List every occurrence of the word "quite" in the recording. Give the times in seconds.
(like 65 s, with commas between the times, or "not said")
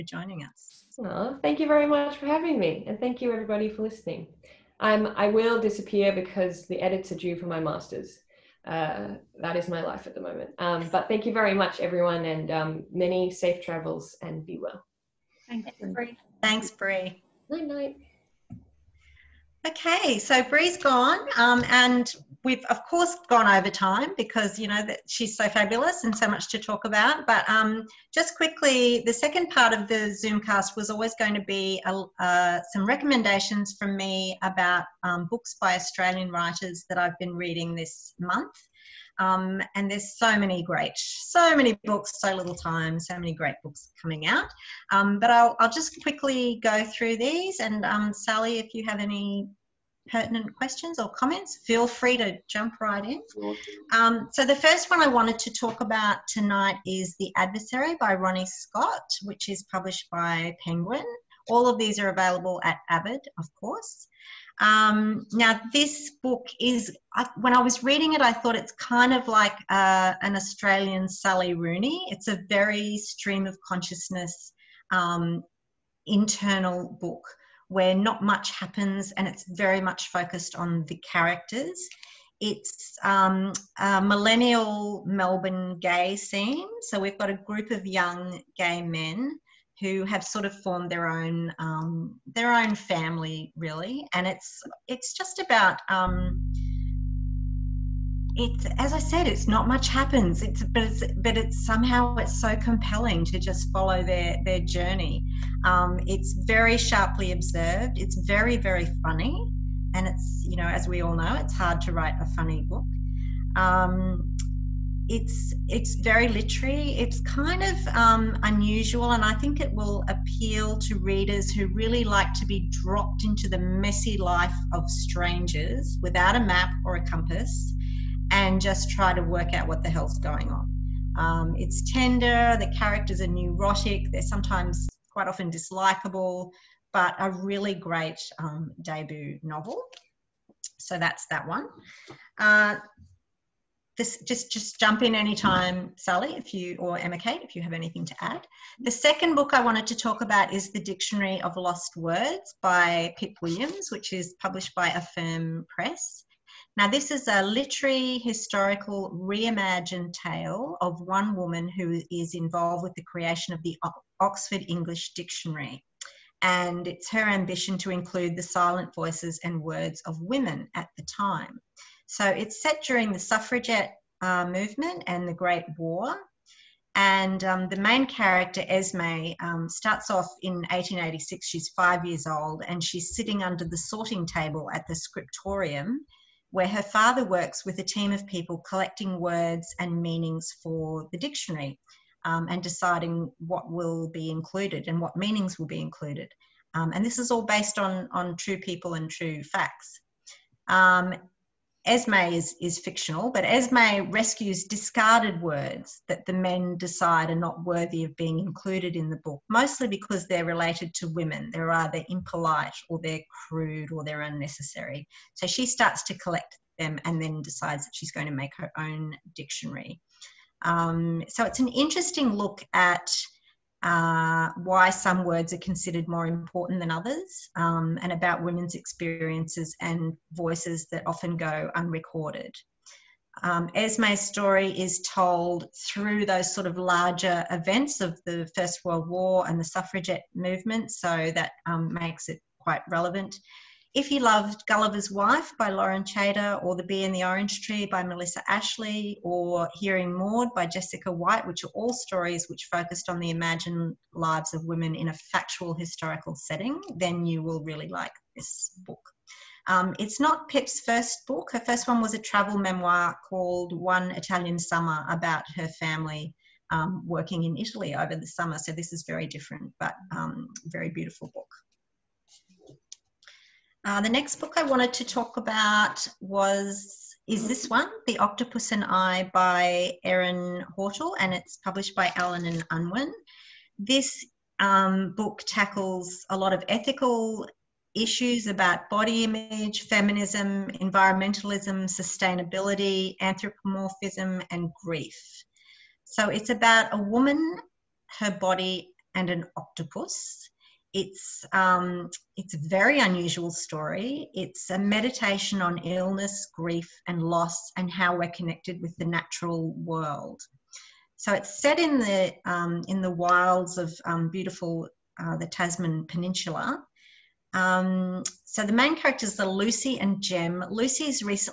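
135 s, 242 s.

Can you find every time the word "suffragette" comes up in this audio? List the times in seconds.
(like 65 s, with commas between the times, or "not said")
173 s, 239 s.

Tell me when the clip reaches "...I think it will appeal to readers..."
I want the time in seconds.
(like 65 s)
119 s.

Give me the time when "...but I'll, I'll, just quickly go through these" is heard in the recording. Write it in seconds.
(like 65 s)
45 s.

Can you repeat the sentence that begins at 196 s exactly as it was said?
Um, and this is all based on, on true people and true facts.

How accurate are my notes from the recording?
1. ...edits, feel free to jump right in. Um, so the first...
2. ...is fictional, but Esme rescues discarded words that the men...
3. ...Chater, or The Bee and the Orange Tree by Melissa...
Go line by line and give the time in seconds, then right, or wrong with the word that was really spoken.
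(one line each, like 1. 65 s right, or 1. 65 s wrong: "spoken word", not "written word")
1. 51 s wrong: "comments", not "edits"
2. 202 s right
3. 246 s right.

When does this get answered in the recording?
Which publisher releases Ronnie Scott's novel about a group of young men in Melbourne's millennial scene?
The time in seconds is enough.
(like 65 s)
60 s.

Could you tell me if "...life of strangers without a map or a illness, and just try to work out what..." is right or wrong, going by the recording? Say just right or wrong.
wrong.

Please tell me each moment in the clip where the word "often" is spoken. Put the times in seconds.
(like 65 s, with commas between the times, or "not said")
135 s, 231 s.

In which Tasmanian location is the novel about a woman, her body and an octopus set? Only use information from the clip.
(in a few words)
Tasman Peninsula.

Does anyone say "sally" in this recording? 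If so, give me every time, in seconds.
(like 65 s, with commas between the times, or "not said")
48 s, 71 s, 145 s.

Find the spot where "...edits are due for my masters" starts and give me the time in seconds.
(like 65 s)
6 s.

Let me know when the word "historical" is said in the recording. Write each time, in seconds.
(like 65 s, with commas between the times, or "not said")
158 s, 255 s.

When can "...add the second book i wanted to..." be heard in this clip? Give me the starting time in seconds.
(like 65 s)
148 s.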